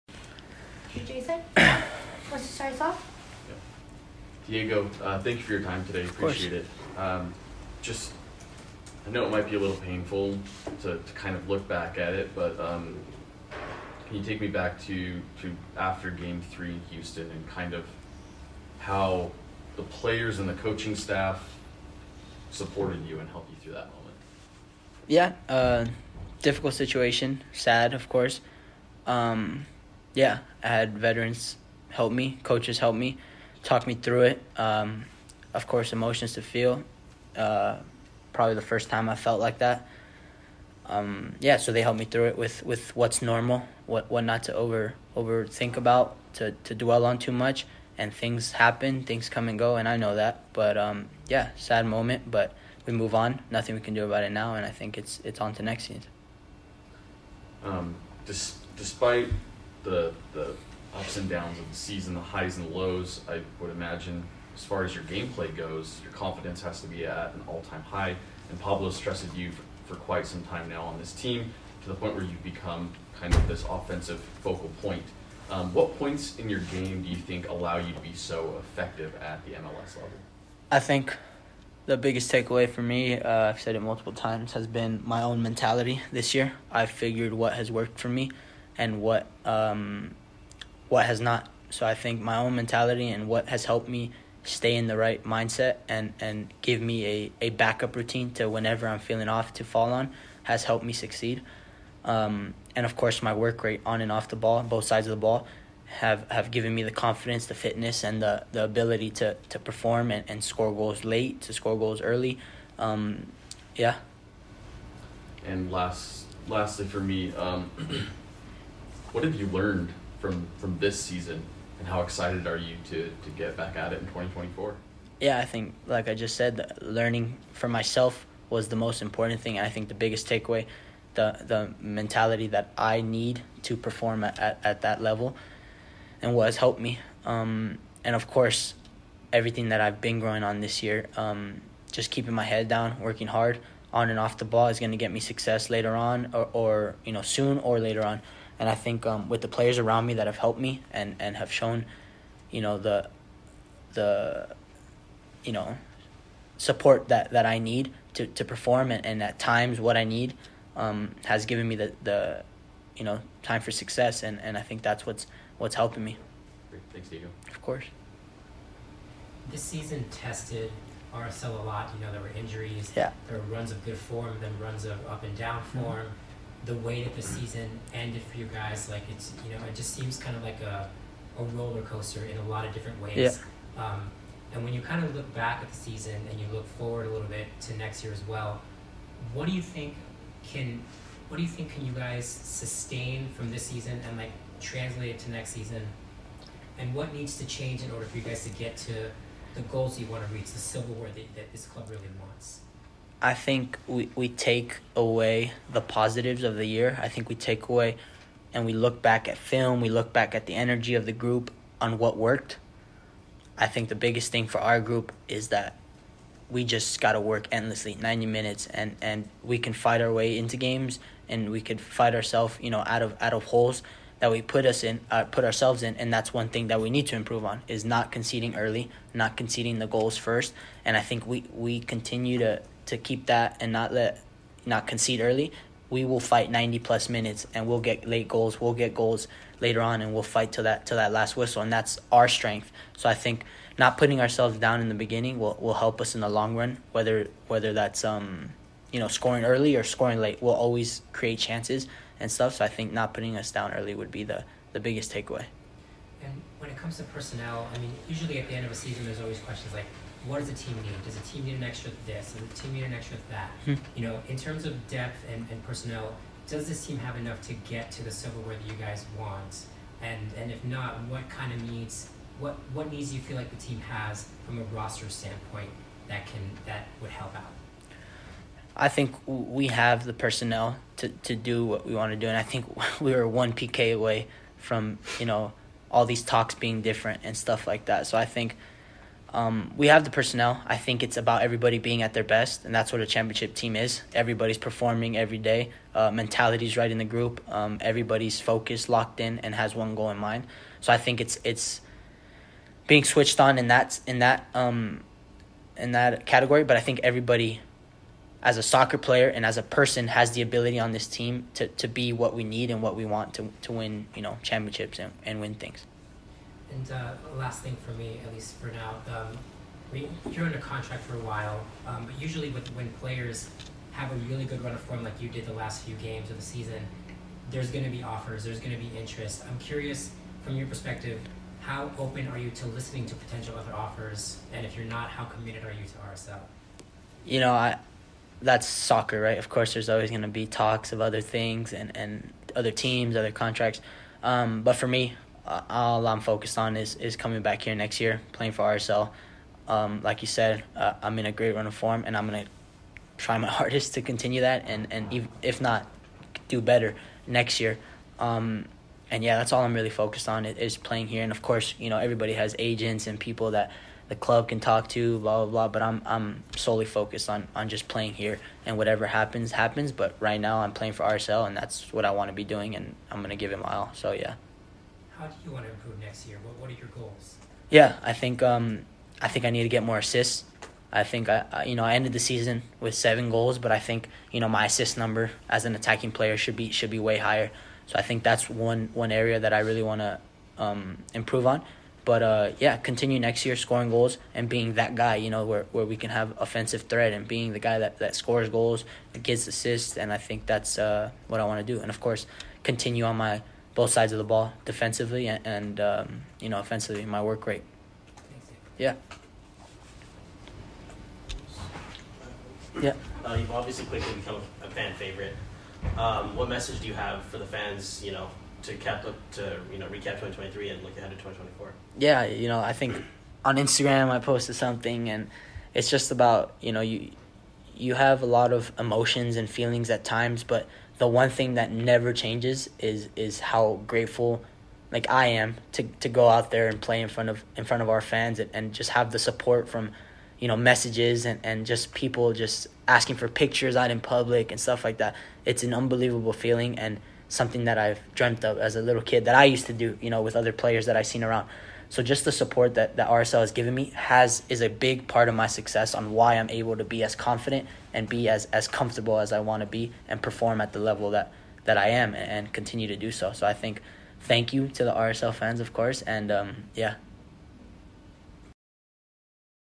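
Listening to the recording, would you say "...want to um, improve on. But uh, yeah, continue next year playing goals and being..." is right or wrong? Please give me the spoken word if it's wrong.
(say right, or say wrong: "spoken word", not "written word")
wrong: "scoring", not "playing".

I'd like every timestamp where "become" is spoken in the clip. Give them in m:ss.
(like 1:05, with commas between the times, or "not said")
1:12, 6:54.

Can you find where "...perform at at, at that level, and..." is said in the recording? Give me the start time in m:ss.
2:13.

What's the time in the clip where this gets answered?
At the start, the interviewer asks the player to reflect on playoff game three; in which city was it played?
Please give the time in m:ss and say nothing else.
0:16.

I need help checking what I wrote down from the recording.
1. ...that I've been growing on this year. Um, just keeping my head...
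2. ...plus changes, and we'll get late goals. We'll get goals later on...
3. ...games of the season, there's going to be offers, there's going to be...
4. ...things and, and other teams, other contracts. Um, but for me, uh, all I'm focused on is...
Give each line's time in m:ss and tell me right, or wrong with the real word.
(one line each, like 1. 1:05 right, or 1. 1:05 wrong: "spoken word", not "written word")
1. 2:19 right
2. 3:56 wrong: "minutes", not "changes"
3. 5:25 right
4. 5:41 right.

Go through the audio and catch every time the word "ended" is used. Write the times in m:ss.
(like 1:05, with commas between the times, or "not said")
2:57, 6:21.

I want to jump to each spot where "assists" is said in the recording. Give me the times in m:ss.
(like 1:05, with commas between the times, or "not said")
6:19, 6:24, 6:39.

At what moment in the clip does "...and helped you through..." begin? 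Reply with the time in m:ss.
0:23.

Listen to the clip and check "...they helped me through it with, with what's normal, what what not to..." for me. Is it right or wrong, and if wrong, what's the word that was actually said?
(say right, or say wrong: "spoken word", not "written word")
right.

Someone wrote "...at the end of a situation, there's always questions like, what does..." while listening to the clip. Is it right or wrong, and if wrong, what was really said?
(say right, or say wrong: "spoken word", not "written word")
wrong: "season", not "situation".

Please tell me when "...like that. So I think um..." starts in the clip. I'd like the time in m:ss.
4:47.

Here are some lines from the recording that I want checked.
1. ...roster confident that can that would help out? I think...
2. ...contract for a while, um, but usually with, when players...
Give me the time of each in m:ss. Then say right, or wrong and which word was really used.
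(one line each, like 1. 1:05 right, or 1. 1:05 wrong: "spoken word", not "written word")
1. 4:34 wrong: "standpoint", not "confident"
2. 5:20 right.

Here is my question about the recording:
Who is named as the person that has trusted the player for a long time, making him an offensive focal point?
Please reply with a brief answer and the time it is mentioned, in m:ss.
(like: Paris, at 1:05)
Pablo, at 1:08.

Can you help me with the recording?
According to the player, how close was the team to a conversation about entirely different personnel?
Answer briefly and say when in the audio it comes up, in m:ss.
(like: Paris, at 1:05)
One PK, at 4:43.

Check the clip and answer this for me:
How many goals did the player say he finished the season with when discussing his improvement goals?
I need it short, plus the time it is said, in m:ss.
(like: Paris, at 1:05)
7, at 6:22.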